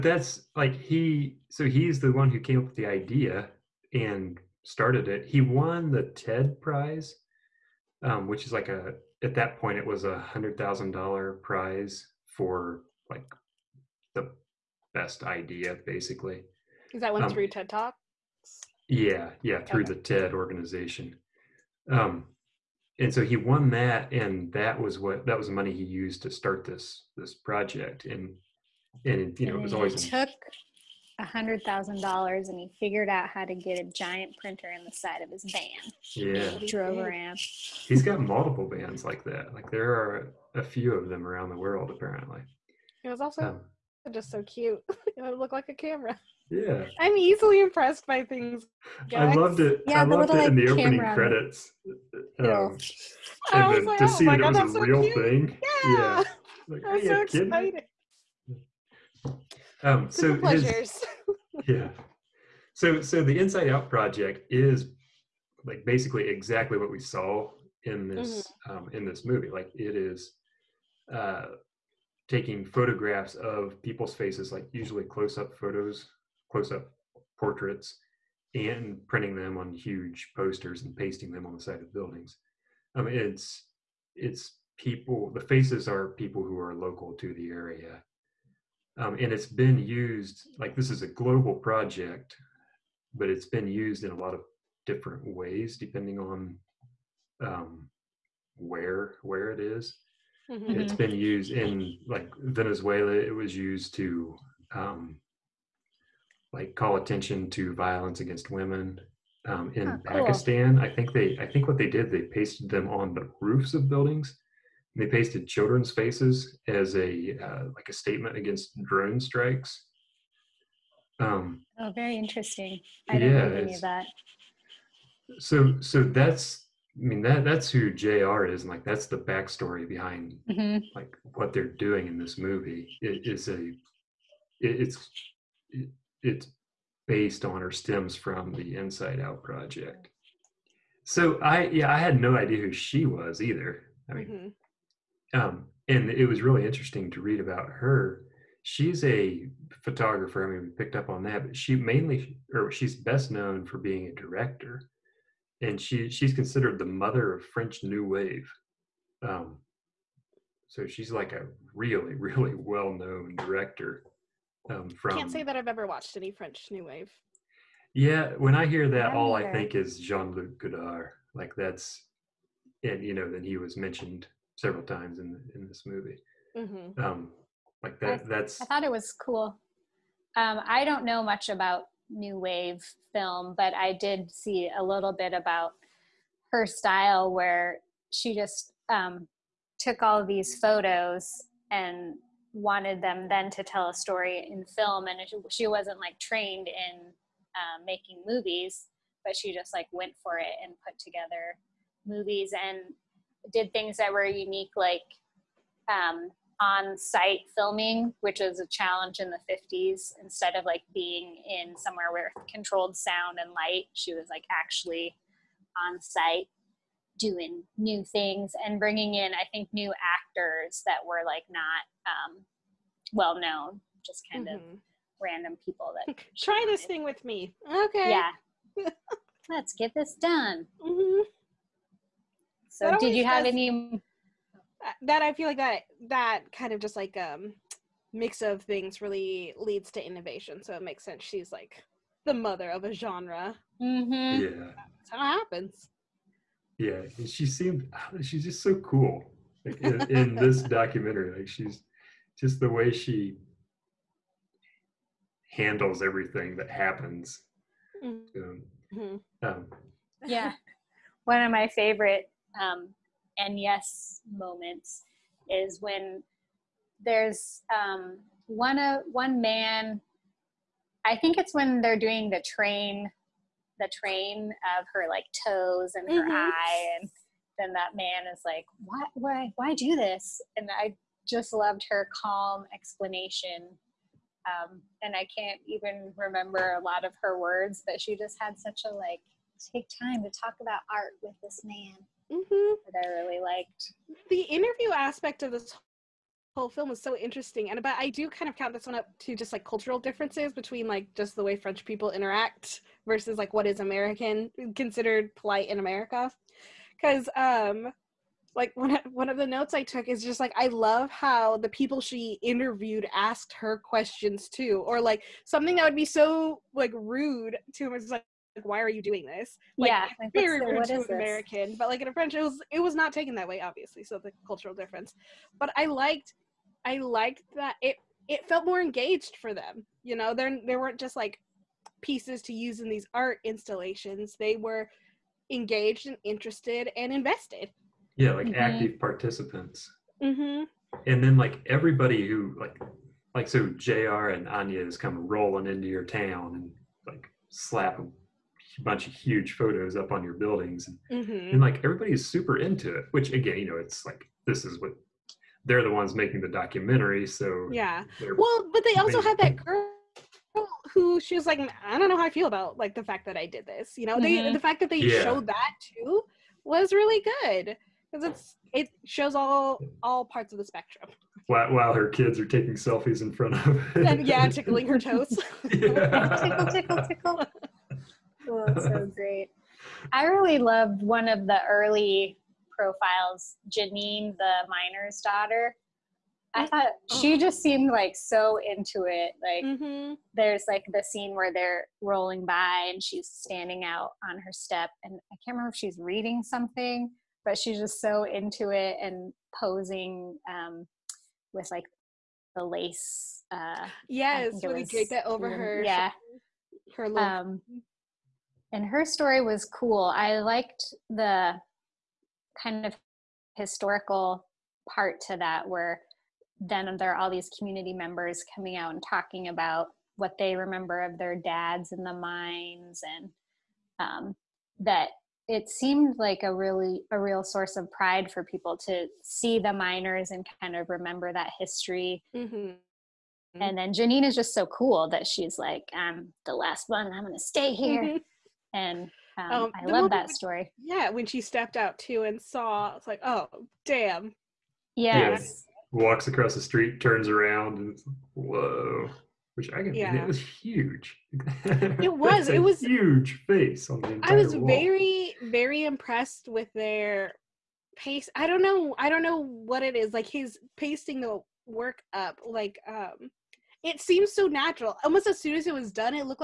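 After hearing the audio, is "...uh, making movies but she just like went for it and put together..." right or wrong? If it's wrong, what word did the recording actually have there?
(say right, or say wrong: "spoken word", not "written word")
right.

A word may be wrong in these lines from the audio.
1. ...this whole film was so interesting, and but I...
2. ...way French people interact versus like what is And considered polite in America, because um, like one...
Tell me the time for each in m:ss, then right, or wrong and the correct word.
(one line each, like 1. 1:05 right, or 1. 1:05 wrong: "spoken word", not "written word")
1. 4:55 right
2. 5:01 wrong: "American", not "And".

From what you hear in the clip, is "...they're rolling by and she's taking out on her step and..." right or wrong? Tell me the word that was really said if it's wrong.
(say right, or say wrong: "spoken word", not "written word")
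wrong: "standing", not "taking".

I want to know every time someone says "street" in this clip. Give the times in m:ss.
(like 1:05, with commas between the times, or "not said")
7:26.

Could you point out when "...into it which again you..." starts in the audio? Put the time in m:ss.
5:52.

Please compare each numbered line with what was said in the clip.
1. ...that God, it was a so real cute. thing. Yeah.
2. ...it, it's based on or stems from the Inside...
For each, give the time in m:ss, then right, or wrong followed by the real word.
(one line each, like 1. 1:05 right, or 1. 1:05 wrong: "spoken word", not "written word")
1. 0:54 right
2. 2:15 right.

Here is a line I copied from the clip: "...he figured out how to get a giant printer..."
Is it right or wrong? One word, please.
right.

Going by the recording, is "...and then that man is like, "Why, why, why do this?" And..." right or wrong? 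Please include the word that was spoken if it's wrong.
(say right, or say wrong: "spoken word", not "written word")
right.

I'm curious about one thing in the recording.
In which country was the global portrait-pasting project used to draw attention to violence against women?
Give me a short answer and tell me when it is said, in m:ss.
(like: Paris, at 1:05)
Venezuela, at 1:42.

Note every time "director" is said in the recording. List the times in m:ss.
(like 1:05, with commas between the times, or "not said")
2:34, 2:43.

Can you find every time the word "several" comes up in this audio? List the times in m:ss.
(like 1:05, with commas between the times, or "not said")
2:54.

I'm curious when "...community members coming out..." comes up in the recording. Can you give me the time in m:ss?
6:57.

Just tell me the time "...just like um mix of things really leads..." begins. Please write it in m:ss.
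3:56.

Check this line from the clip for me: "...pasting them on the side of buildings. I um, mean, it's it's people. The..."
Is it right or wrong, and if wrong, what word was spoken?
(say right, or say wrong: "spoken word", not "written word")
right.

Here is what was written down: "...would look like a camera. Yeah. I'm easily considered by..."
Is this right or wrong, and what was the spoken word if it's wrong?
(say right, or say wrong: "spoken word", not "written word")
wrong: "impressed", not "considered".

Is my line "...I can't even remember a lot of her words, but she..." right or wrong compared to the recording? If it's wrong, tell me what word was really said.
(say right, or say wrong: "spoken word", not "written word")
right.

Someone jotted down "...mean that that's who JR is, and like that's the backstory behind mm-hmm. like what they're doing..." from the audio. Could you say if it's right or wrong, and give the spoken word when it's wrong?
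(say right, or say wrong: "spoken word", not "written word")
right.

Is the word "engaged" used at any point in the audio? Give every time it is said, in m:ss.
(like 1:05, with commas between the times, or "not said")
5:28, 5:35.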